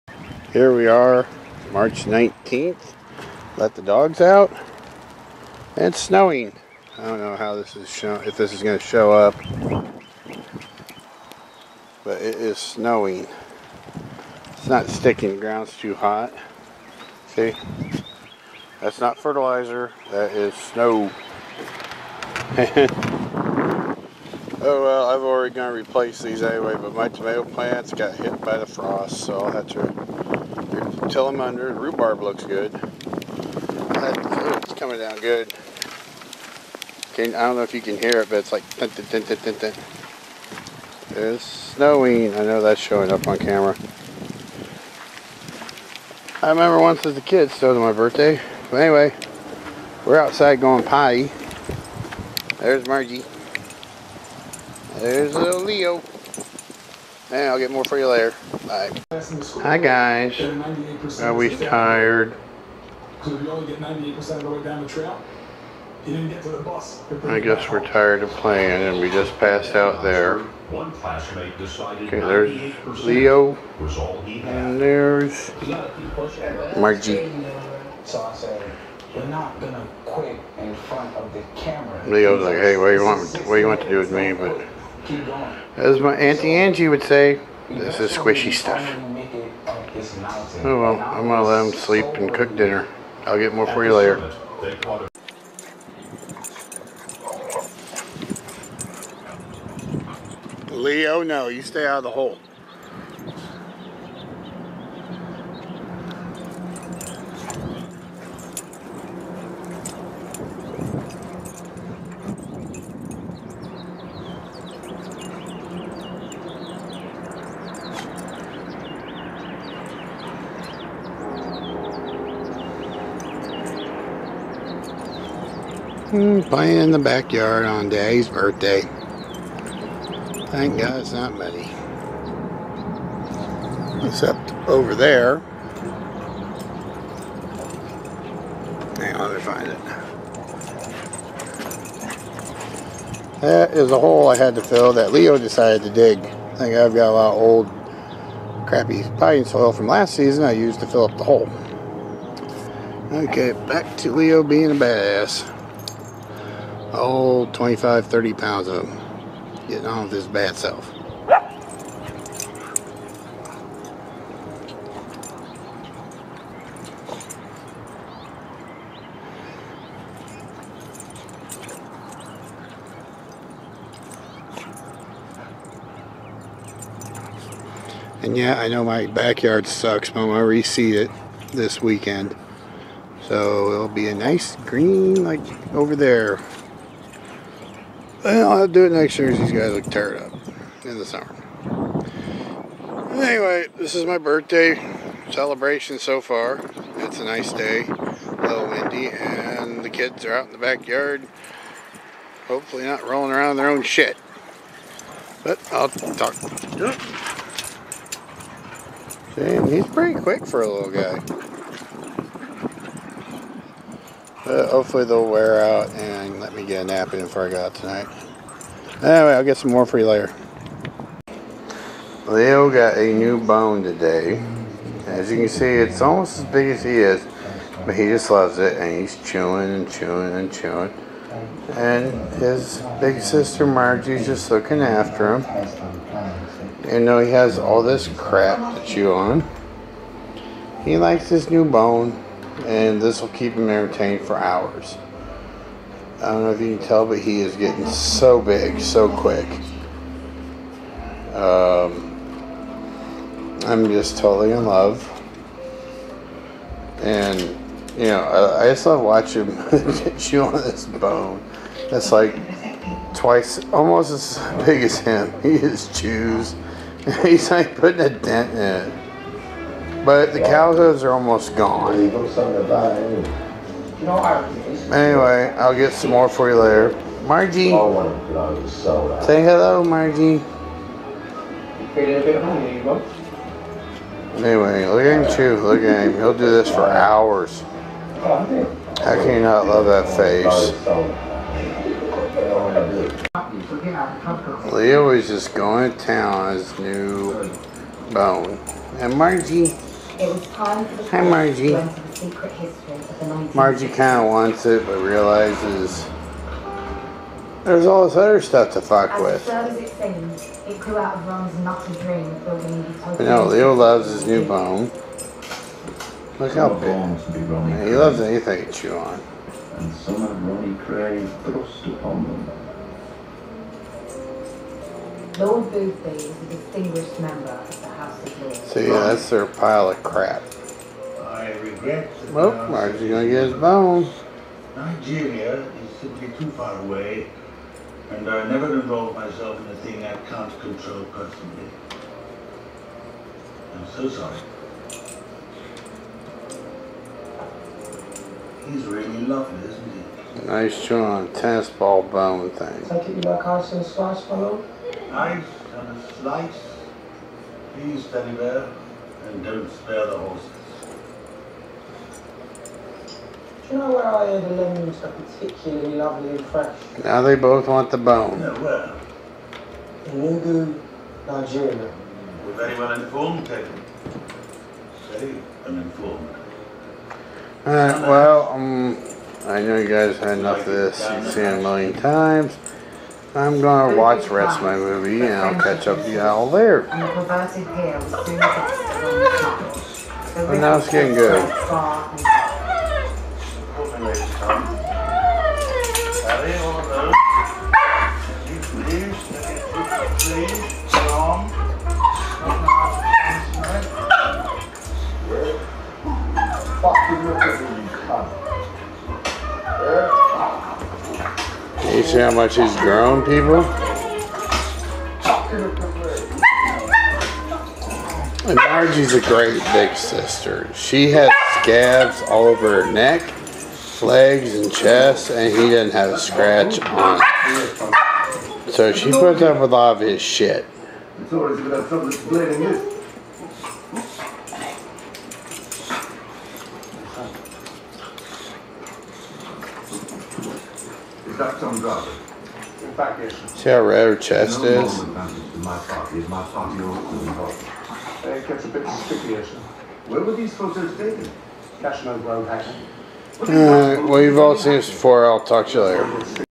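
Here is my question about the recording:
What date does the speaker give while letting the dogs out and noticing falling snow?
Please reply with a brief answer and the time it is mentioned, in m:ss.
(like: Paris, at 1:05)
March 19th, at 0:01.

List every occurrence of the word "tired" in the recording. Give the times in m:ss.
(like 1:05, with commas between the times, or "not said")
1:01, 1:07, 3:09.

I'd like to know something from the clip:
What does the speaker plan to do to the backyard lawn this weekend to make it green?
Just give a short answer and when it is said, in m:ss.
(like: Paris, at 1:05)
Reseed it, at 3:00.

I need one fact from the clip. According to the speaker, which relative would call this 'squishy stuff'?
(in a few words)
Auntie Angie.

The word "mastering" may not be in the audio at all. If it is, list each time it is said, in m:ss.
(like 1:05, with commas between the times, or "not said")
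not said.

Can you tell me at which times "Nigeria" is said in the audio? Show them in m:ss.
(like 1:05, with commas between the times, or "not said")
5:34, 6:11.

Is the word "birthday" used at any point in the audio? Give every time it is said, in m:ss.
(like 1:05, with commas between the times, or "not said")
0:47, 2:08, 3:14.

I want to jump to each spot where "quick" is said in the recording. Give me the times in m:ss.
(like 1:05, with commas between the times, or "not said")
3:30, 4:09.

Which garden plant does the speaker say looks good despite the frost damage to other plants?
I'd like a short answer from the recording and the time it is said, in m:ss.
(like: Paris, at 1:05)
Rhubarb, at 0:31.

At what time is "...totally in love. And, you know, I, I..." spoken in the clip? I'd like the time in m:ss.
4:14.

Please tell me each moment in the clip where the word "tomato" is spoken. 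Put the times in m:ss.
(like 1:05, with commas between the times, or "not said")
0:27.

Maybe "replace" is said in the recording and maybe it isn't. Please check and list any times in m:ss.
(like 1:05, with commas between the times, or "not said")
0:25.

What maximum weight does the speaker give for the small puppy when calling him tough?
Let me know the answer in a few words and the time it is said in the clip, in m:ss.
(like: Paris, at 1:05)
30 pounds, at 2:38.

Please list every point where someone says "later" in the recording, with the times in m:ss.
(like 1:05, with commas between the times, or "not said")
0:58, 1:33, 3:40, 4:36, 7:35.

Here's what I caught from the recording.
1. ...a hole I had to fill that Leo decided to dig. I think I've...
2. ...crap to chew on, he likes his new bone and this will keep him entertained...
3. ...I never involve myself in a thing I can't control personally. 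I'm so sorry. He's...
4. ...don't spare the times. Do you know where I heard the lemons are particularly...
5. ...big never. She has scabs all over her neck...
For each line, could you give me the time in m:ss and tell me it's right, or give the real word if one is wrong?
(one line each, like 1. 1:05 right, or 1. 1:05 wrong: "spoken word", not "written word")
1. 2:23 right
2. 3:58 right
3. 5:38 right
4. 5:59 wrong: "horses", not "times"
5. 6:59 wrong: "sister", not "never".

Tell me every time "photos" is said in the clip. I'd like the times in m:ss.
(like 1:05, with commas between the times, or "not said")
7:30.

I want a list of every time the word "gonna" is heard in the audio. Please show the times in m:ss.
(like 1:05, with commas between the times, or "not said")
0:25, 1:19, 1:31, 5:33, 6:23.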